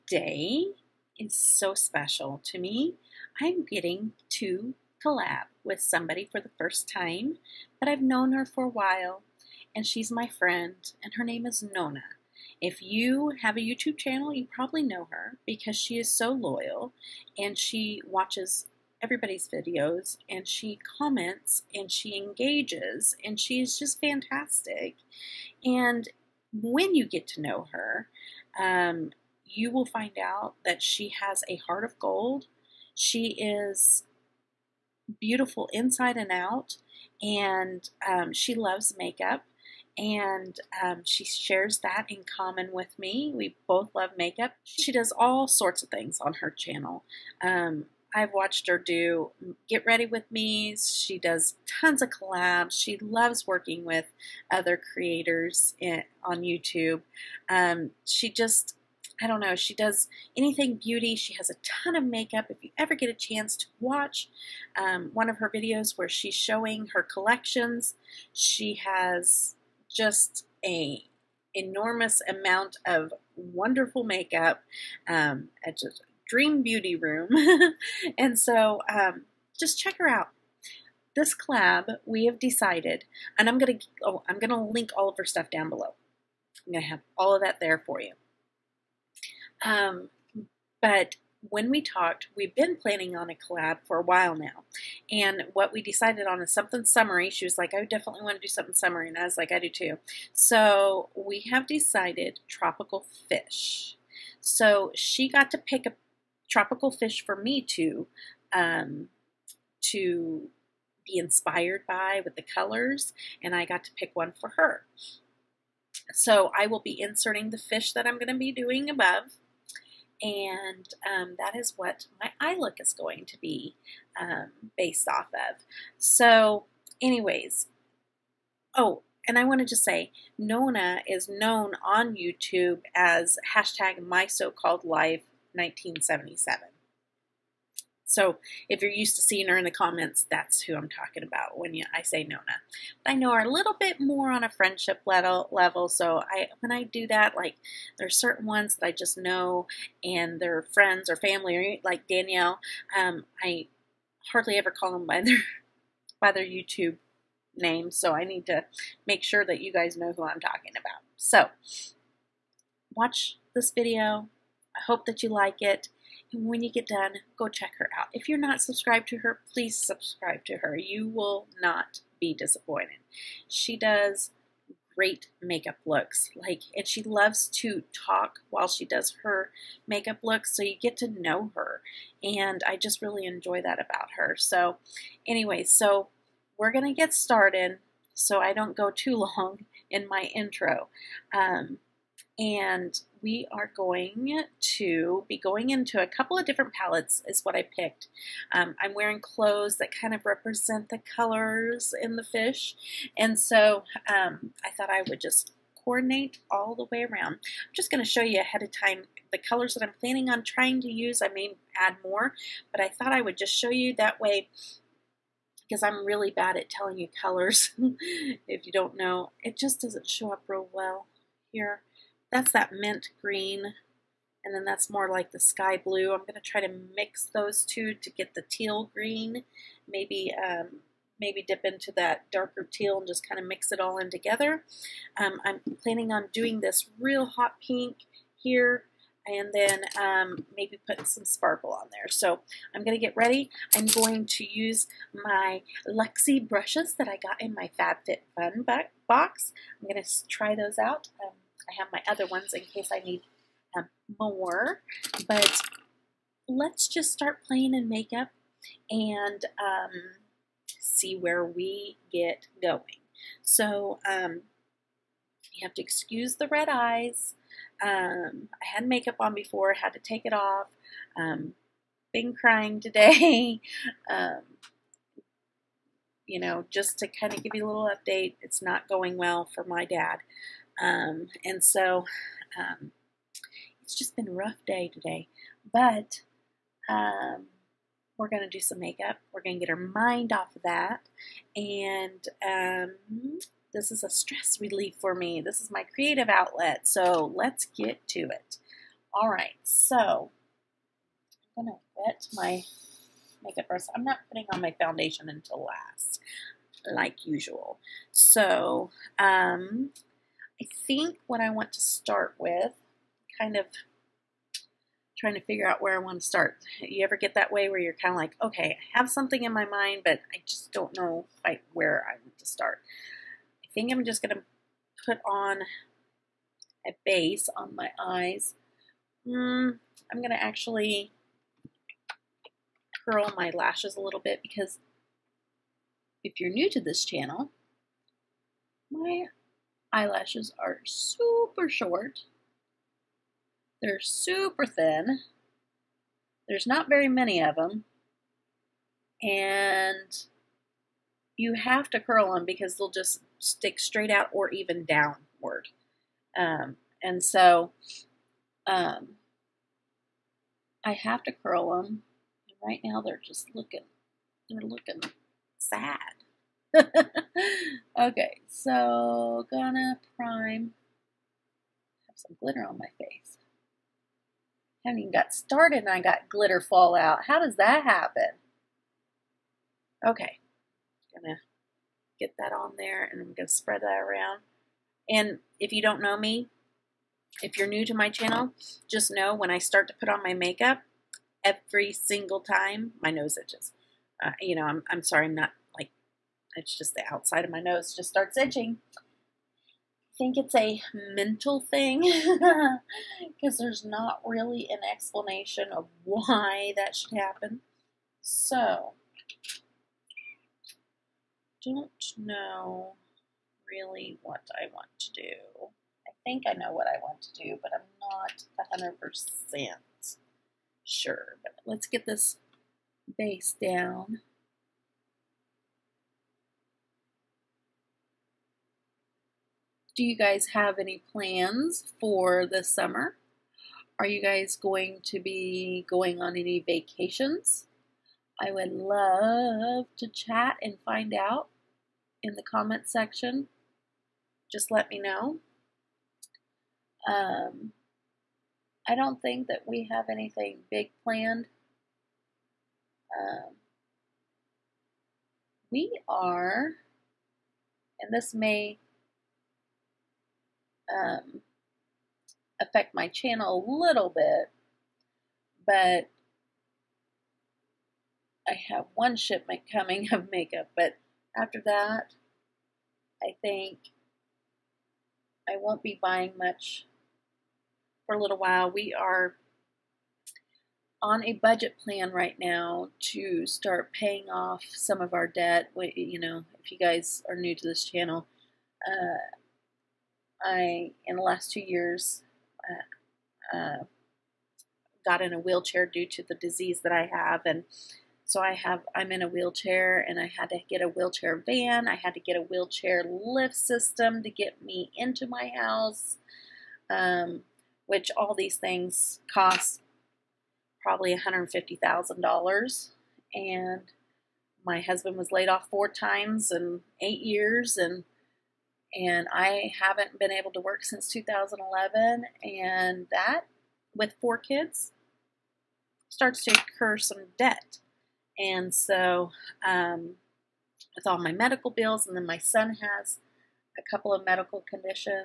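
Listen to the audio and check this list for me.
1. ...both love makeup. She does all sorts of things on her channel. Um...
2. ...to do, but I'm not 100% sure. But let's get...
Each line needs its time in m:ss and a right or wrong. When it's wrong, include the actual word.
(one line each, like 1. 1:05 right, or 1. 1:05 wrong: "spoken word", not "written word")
1. 0:43 right
2. 6:57 right.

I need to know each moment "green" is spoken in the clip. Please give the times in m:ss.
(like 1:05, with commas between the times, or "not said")
3:43, 3:48.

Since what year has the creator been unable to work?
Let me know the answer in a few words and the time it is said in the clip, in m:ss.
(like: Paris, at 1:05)
2011, at 8:41.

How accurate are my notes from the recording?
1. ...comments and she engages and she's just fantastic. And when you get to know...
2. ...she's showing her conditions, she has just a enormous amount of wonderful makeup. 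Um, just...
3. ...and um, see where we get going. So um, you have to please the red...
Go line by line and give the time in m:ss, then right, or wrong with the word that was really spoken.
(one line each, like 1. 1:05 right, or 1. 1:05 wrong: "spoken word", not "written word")
1. 0:20 right
2. 1:06 wrong: "collections", not "conditions"
3. 4:18 wrong: "excuse", not "please".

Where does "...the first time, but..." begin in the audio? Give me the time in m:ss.
0:06.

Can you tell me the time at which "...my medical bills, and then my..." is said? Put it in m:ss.
8:51.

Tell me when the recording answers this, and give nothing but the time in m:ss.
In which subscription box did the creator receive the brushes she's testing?
4:07.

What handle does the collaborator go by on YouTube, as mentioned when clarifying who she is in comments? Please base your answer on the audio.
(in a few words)
my so called life 1977.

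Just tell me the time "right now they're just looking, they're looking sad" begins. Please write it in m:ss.
6:02.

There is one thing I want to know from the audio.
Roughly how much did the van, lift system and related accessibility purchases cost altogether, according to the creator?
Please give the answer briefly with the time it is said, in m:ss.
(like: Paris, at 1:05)
$150,000, at 8:31.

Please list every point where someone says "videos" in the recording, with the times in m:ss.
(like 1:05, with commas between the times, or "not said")
0:19, 1:05, 2:43.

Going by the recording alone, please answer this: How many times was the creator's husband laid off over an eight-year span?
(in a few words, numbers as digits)
4.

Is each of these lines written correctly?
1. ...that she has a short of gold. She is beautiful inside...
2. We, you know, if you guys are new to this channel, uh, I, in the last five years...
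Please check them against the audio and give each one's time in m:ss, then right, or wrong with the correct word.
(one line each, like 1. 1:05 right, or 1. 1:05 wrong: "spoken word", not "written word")
1. 0:30 wrong: "heart", not "short"
2. 8:05 wrong: "two", not "five".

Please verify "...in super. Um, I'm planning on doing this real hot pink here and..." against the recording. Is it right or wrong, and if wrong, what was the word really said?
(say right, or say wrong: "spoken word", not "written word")
wrong: "together", not "super".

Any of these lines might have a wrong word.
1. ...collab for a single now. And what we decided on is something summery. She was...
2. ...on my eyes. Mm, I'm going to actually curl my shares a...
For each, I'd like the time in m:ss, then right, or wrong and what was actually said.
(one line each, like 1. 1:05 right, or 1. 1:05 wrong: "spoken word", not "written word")
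1. 1:33 wrong: "while", not "single"
2. 5:27 wrong: "lashes", not "shares".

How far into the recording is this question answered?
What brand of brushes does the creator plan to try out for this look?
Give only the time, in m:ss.
4:05.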